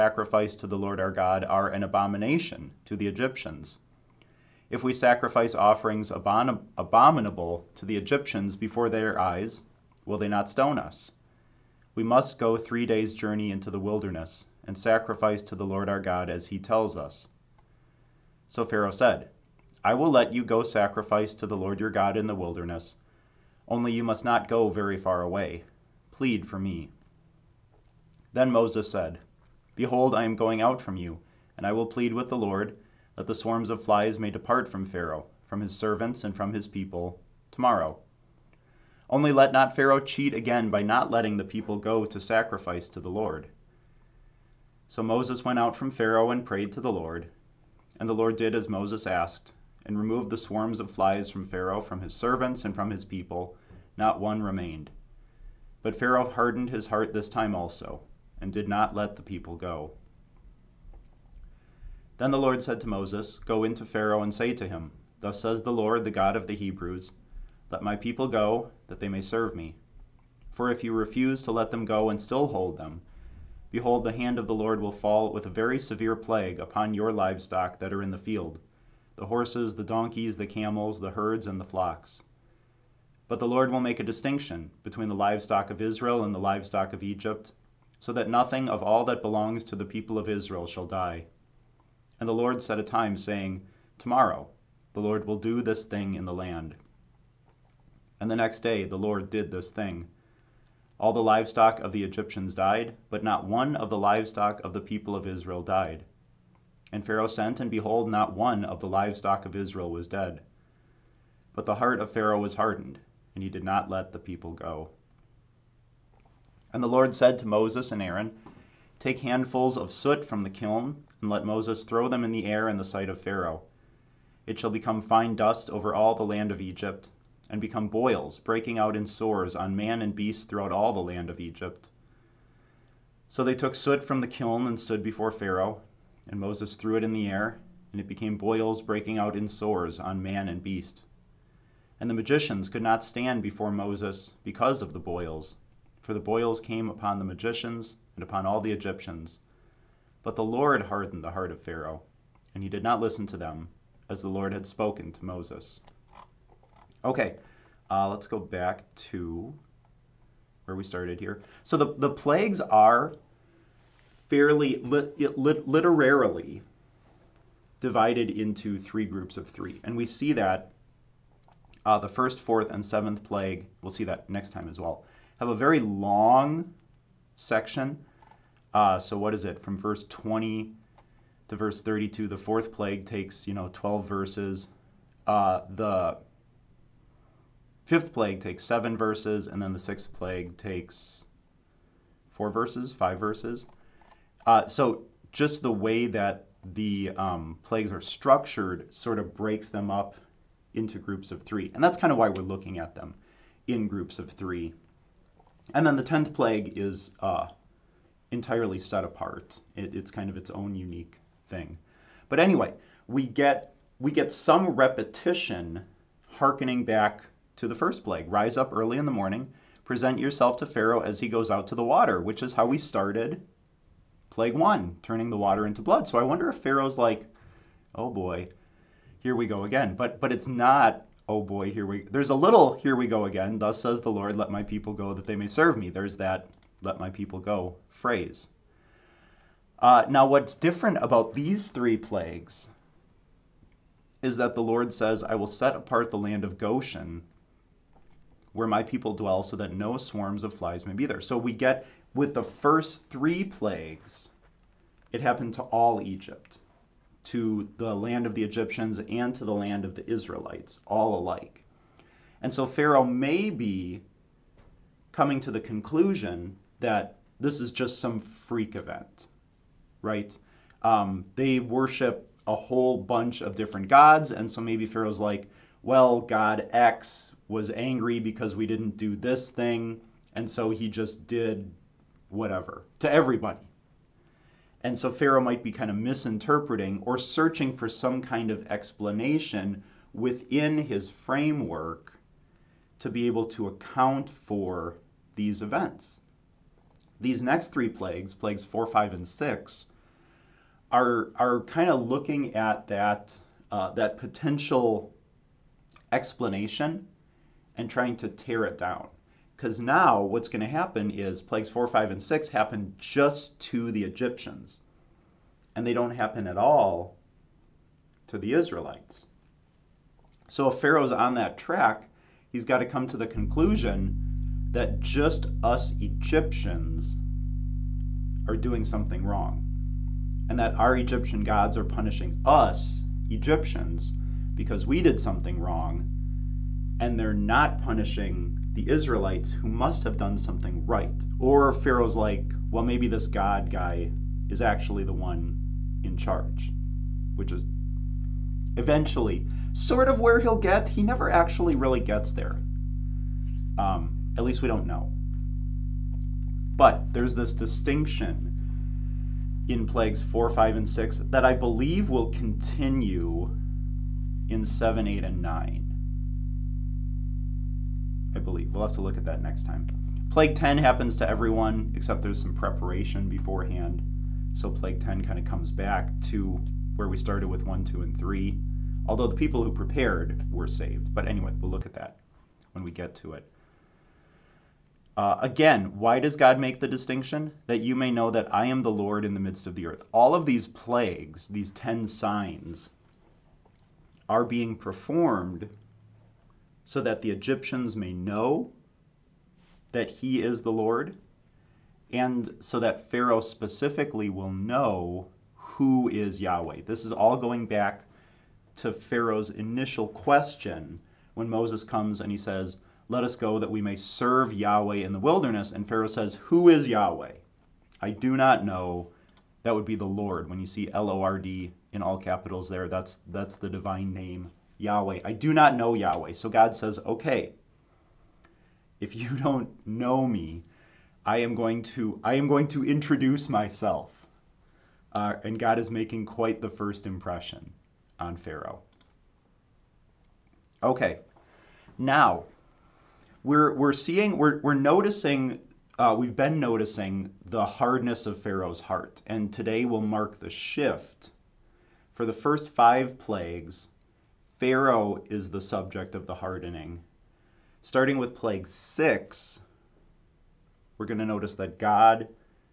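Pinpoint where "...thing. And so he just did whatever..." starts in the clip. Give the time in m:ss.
4:39.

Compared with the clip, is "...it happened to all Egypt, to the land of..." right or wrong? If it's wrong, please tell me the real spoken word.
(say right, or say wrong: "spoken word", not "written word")
right.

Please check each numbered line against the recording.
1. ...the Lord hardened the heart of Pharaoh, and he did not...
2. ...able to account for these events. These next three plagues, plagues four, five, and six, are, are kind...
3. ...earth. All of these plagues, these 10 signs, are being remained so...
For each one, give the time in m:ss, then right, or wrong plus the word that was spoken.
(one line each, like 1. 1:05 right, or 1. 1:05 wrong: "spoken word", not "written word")
1. 2:30 right
2. 4:53 right
3. 6:29 wrong: "performed", not "remained".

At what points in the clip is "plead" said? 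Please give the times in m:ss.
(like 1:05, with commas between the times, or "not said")
0:26, 0:31.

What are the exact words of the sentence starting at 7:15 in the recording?
Uh, and God is making quite the first impression on Pharaoh.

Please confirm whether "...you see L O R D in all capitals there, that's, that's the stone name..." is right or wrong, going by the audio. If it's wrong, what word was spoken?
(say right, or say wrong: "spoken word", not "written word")
wrong: "divine", not "stone".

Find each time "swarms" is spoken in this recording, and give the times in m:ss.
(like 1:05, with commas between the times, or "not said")
0:33, 0:50, 4:09.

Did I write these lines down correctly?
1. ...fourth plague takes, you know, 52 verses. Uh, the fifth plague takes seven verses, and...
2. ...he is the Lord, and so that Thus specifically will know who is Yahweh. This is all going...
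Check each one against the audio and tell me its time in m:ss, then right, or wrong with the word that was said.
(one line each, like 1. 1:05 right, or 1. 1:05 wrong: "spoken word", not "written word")
1. 3:02 wrong: "12", not "52"
2. 6:40 wrong: "Pharaoh", not "Thus".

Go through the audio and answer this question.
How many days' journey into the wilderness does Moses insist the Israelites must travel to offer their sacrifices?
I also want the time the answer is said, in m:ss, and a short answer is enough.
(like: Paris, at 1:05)
3, at 0:12.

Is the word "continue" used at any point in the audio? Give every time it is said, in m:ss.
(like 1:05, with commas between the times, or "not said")
6:02.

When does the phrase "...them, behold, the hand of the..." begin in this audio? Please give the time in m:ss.
1:12.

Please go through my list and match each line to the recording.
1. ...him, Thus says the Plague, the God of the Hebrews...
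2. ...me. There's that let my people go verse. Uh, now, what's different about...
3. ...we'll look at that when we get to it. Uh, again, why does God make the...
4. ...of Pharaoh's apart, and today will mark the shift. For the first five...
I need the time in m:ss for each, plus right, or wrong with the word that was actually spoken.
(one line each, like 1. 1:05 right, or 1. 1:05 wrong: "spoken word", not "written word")
1. 1:04 wrong: "Lord", not "Plague"
2. 3:55 wrong: "phrase", not "verse"
3. 6:21 right
4. 7:28 wrong: "heart", not "apart".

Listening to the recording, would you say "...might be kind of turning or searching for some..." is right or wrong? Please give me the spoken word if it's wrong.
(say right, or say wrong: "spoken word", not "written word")
wrong: "misinterpreting", not "turning".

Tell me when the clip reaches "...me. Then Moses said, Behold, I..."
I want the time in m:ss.
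0:26.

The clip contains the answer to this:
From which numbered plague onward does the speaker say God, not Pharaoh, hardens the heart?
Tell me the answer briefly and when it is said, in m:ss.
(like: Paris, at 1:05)
6, at 7:38.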